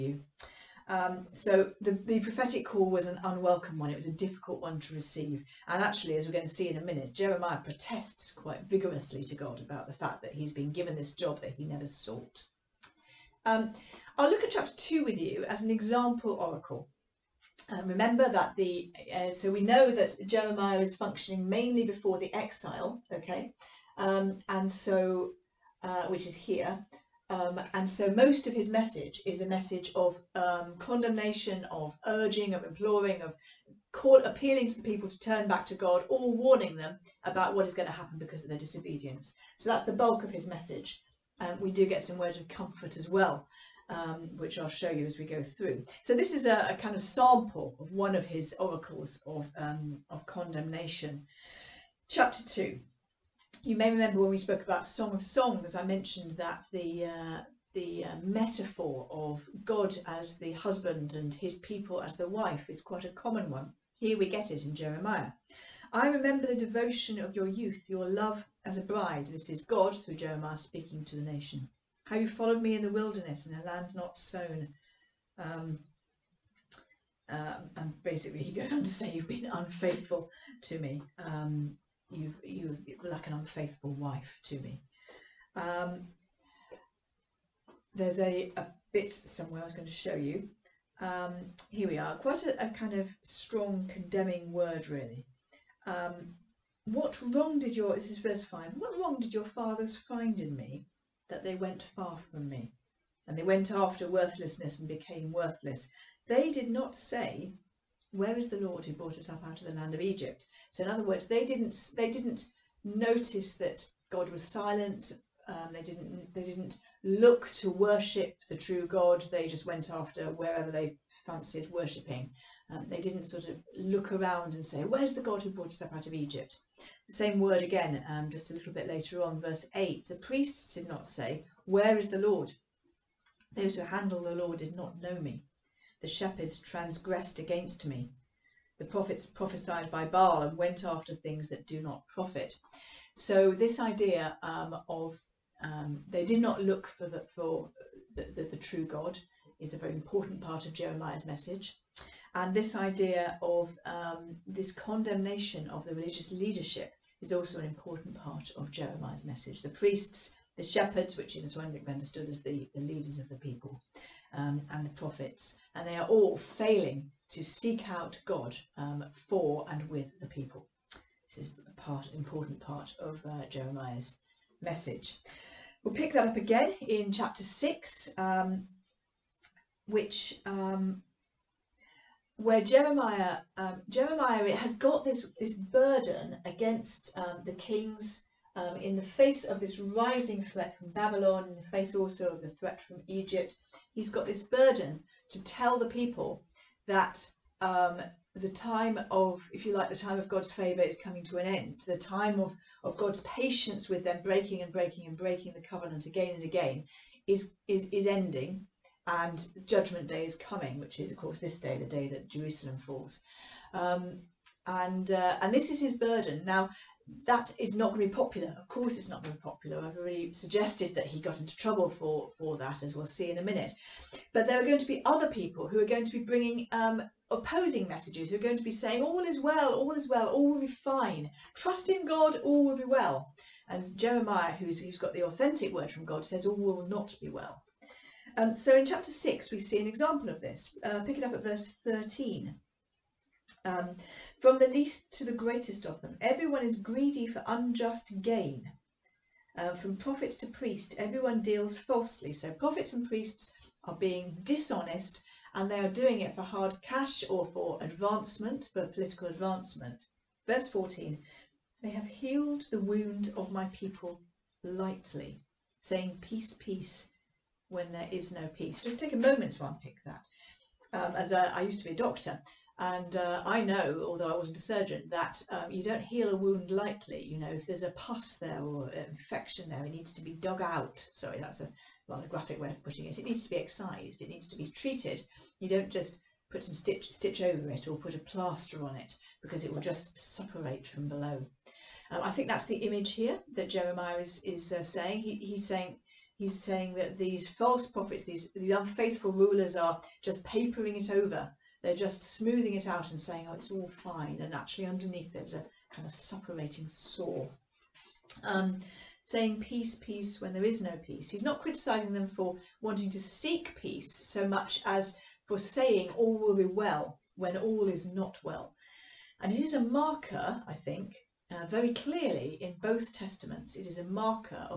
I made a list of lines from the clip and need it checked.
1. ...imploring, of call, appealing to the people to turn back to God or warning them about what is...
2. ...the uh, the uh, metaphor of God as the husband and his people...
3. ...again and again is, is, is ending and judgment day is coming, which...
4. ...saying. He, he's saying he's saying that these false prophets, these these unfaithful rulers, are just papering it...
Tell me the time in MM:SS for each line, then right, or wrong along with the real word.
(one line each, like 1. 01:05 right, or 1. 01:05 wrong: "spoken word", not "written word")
1. 00:32 right
2. 00:56 right
3. 03:26 right
4. 04:54 right.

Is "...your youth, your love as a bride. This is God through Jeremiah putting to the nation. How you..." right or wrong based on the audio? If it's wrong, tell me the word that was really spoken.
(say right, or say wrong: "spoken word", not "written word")
wrong: "speaking", not "putting".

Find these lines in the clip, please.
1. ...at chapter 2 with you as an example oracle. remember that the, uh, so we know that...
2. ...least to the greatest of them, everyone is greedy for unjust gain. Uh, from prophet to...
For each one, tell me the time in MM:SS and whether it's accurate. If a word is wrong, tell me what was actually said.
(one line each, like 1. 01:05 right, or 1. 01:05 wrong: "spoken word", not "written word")
1. 00:14 right
2. 04:04 right.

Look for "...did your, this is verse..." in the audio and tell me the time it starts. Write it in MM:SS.
01:37.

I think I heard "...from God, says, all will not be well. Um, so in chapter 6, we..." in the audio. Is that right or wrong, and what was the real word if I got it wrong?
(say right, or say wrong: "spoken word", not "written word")
right.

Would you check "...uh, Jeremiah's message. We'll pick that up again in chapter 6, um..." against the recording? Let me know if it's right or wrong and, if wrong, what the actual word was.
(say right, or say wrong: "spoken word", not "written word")
right.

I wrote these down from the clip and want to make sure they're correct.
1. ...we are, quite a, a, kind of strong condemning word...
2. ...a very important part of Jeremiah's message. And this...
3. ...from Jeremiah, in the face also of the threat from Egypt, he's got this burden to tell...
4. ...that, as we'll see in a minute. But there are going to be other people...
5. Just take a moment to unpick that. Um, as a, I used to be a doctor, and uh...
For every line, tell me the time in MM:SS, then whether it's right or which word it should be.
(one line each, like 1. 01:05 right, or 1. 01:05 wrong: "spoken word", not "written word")
1. 01:31 right
2. 02:29 right
3. 03:10 wrong: "Babylon", not "Jeremiah"
4. 03:42 right
5. 04:28 right.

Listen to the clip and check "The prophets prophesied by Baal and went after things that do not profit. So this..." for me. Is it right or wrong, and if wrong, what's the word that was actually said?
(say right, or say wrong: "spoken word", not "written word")
right.